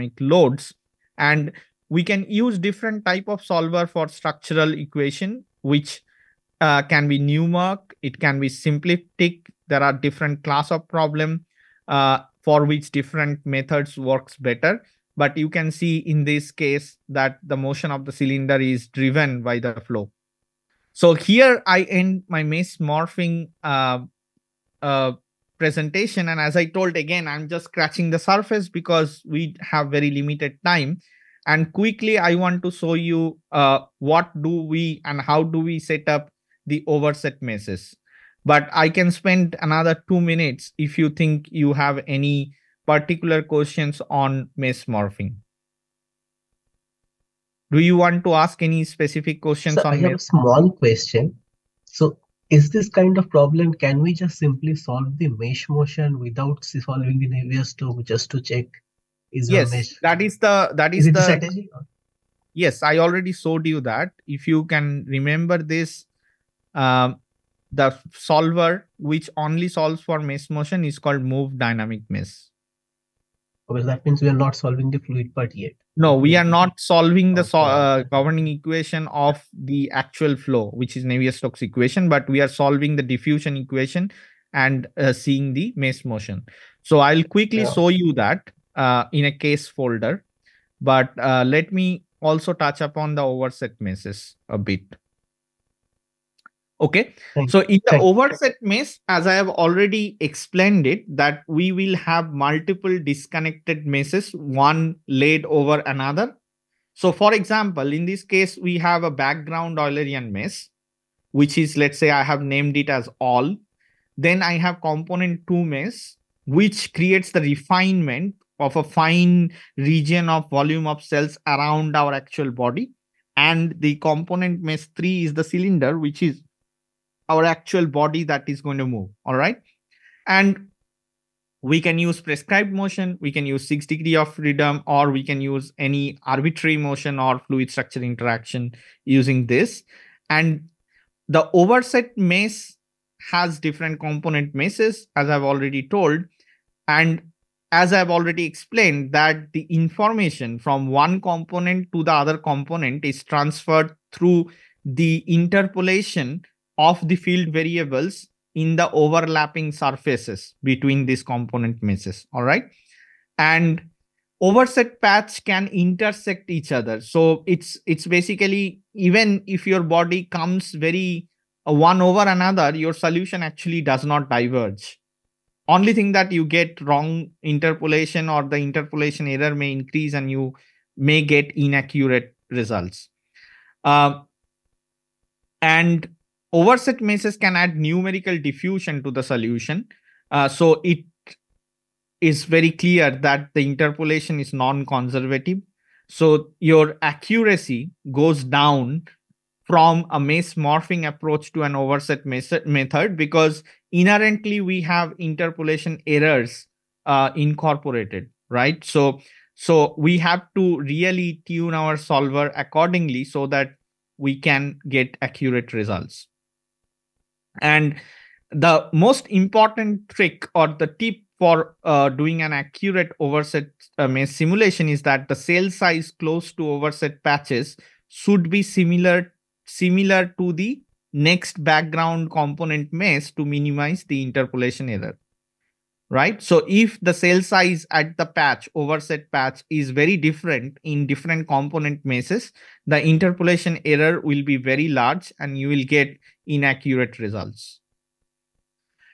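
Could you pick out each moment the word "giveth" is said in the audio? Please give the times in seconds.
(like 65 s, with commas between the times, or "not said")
not said.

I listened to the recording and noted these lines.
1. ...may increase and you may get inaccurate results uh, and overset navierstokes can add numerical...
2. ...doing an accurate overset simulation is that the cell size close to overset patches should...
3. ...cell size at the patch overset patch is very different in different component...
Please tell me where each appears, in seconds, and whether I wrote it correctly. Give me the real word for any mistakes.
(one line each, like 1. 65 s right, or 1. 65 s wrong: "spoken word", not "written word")
1. 179 s wrong: "meshes", not "navierstokes"
2. 222 s right
3. 237 s right.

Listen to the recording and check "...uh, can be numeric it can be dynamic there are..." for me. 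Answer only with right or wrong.
wrong.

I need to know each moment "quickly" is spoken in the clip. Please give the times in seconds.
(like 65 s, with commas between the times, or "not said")
31 s, 87 s.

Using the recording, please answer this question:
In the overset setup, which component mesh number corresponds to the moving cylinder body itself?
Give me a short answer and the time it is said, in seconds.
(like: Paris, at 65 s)
3, at 124 s.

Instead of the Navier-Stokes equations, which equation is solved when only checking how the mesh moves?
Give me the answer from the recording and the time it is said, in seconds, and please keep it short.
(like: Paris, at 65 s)
diffusion equation, at 83 s.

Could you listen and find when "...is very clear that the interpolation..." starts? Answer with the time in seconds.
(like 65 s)
192 s.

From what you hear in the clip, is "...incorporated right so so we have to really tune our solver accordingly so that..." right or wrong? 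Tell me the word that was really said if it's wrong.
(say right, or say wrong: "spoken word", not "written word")
right.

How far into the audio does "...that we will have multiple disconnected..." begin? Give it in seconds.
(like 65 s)
101 s.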